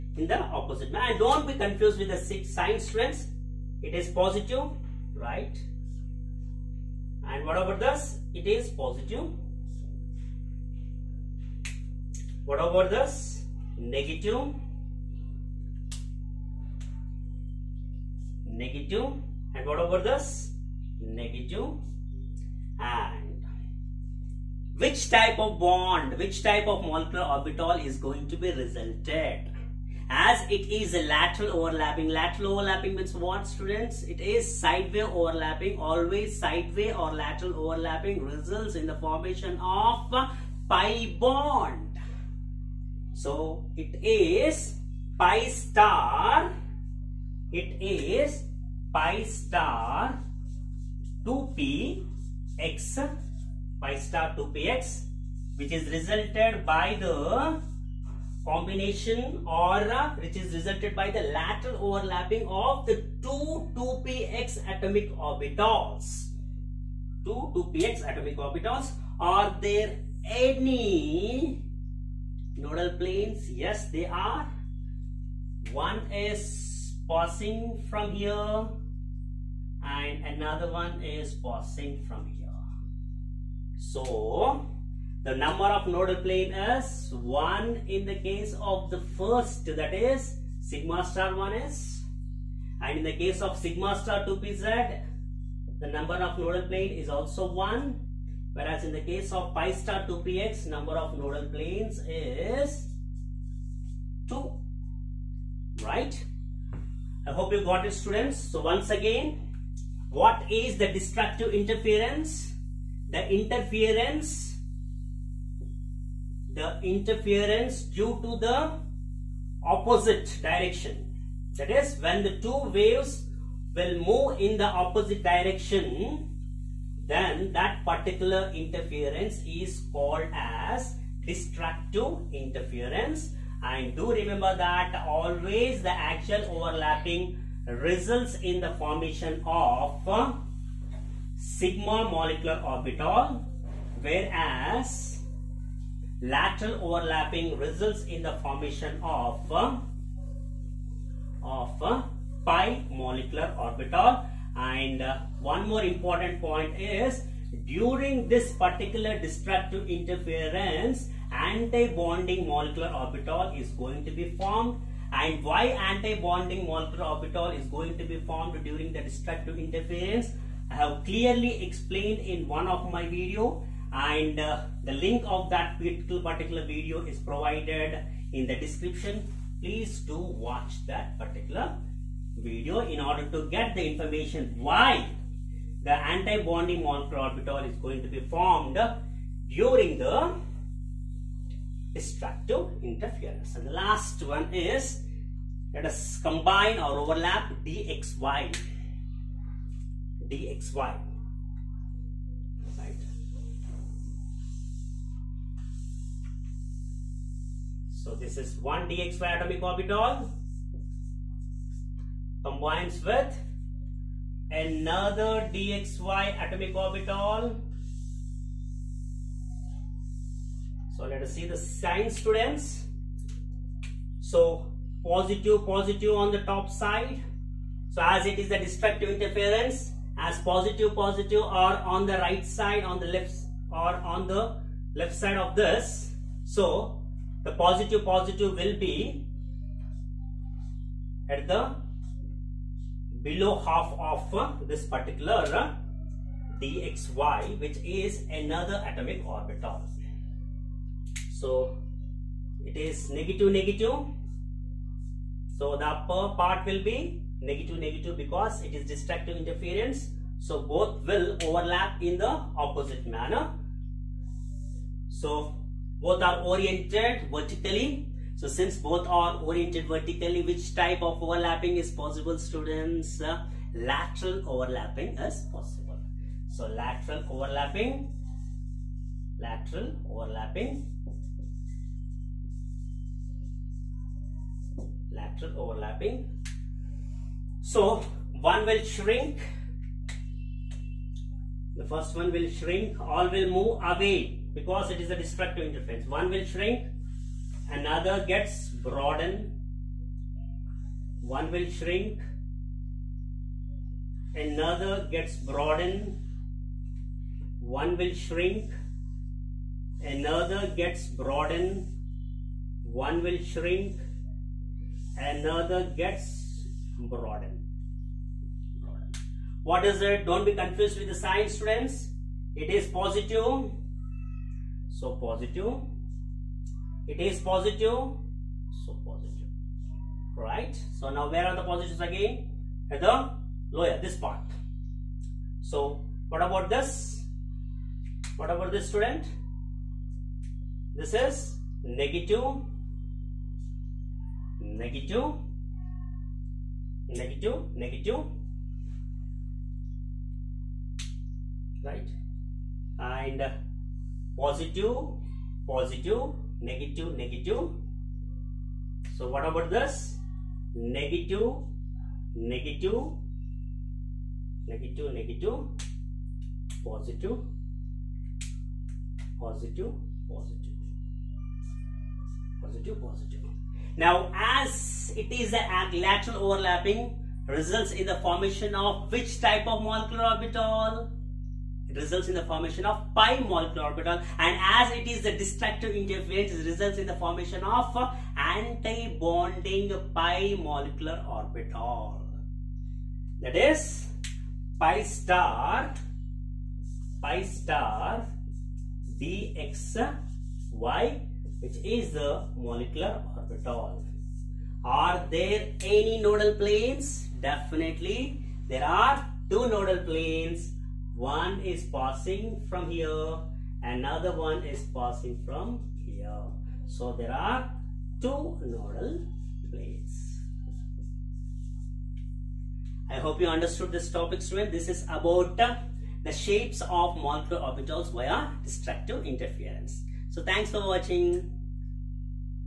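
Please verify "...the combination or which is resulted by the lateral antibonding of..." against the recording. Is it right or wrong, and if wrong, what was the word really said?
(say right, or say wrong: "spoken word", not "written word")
wrong: "overlapping", not "antibonding".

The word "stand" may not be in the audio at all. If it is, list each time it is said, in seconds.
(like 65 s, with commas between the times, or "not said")
not said.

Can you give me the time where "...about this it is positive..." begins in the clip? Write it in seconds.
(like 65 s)
7 s.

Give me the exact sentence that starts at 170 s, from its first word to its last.
I have clearly explained in one of my video and uh, the link of that particular video is provided in the description.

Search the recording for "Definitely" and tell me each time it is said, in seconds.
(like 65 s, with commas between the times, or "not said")
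407 s.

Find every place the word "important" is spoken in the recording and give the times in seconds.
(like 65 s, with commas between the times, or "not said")
155 s.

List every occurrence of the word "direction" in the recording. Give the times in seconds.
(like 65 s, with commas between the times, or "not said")
120 s, 125 s.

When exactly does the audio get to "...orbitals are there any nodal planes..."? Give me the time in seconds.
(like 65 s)
68 s.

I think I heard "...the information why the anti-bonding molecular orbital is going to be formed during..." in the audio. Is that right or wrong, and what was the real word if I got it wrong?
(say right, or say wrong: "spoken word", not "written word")
right.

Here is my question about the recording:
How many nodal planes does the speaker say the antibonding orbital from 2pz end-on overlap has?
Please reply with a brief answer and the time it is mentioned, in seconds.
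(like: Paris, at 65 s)
1, at 95 s.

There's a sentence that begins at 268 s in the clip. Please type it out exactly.
So since both are oriented vertically, which type of overlapping is possible students?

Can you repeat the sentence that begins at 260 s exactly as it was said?
So both will overlap in the opposite manner.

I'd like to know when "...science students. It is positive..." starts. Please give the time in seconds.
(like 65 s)
321 s.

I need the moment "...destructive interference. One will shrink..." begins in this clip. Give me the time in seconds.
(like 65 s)
295 s.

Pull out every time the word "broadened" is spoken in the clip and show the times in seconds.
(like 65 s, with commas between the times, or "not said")
298 s, 305 s, 311 s, 316 s.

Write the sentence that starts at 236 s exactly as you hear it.
So the positive, positive will be at the below half of this particular dxy which is another atomic orbital.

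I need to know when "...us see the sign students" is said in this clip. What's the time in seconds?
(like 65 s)
221 s.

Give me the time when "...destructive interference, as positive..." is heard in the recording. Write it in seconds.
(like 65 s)
228 s.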